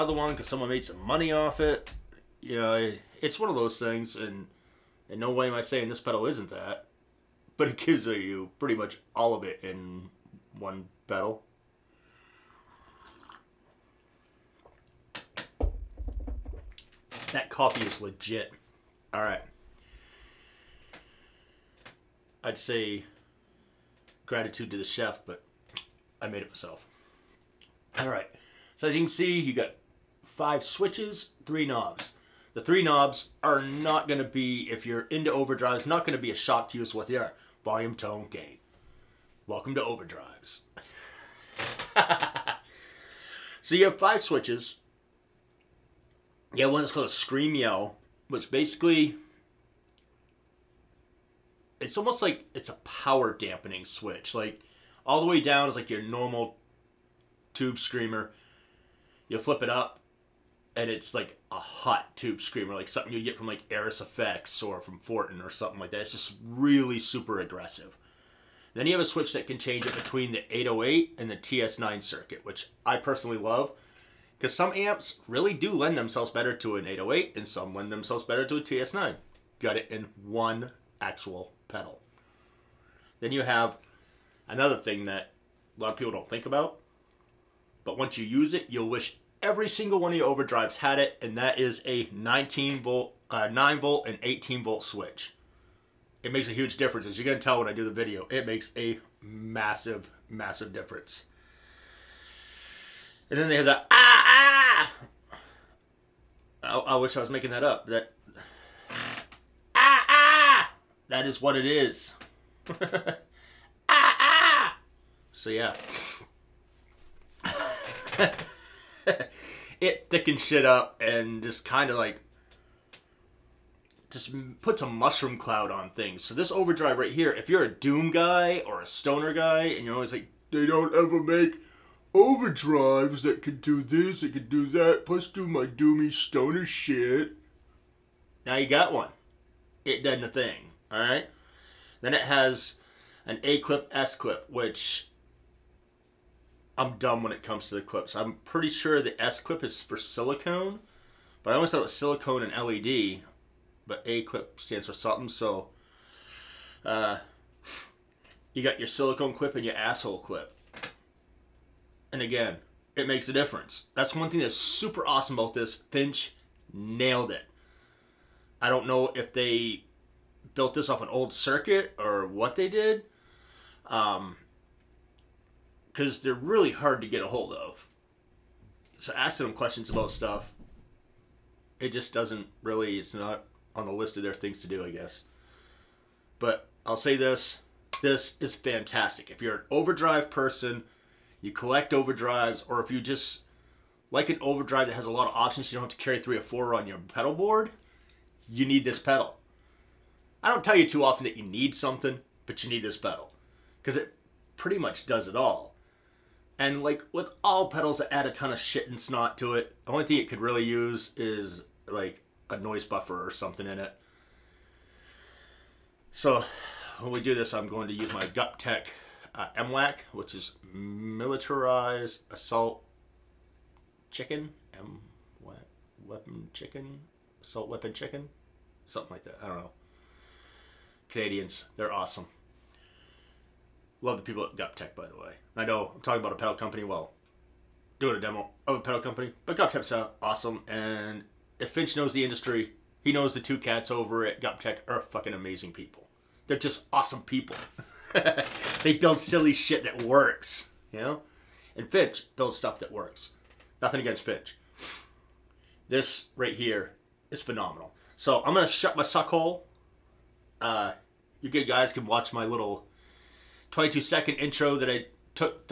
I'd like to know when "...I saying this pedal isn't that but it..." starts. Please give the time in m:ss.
0:05.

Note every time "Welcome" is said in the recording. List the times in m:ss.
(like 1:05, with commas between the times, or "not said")
0:39.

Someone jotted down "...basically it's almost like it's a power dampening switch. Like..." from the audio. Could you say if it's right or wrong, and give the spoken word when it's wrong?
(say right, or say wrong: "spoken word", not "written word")
right.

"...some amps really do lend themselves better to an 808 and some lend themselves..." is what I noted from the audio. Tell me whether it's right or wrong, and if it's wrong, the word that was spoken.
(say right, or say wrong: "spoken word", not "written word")
right.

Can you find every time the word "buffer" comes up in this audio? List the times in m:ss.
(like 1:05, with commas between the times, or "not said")
3:32.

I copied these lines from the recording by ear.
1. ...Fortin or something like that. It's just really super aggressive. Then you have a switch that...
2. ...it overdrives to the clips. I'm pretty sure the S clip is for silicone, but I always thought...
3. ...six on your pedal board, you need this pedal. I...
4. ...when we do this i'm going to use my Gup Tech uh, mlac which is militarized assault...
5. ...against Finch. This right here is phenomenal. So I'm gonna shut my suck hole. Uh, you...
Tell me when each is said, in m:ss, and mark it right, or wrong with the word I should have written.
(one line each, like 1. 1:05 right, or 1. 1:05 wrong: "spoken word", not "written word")
1. 1:04 right
2. 2:27 wrong: "comes", not "overdrives"
3. 3:16 wrong: "four", not "six"
4. 3:36 right
5. 4:14 right.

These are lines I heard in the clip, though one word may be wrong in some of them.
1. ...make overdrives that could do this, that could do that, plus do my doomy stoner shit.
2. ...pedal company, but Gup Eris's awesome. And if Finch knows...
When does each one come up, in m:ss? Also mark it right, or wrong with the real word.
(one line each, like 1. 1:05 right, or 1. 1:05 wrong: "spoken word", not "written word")
1. 2:11 right
2. 3:58 wrong: "Tech", not "Eris".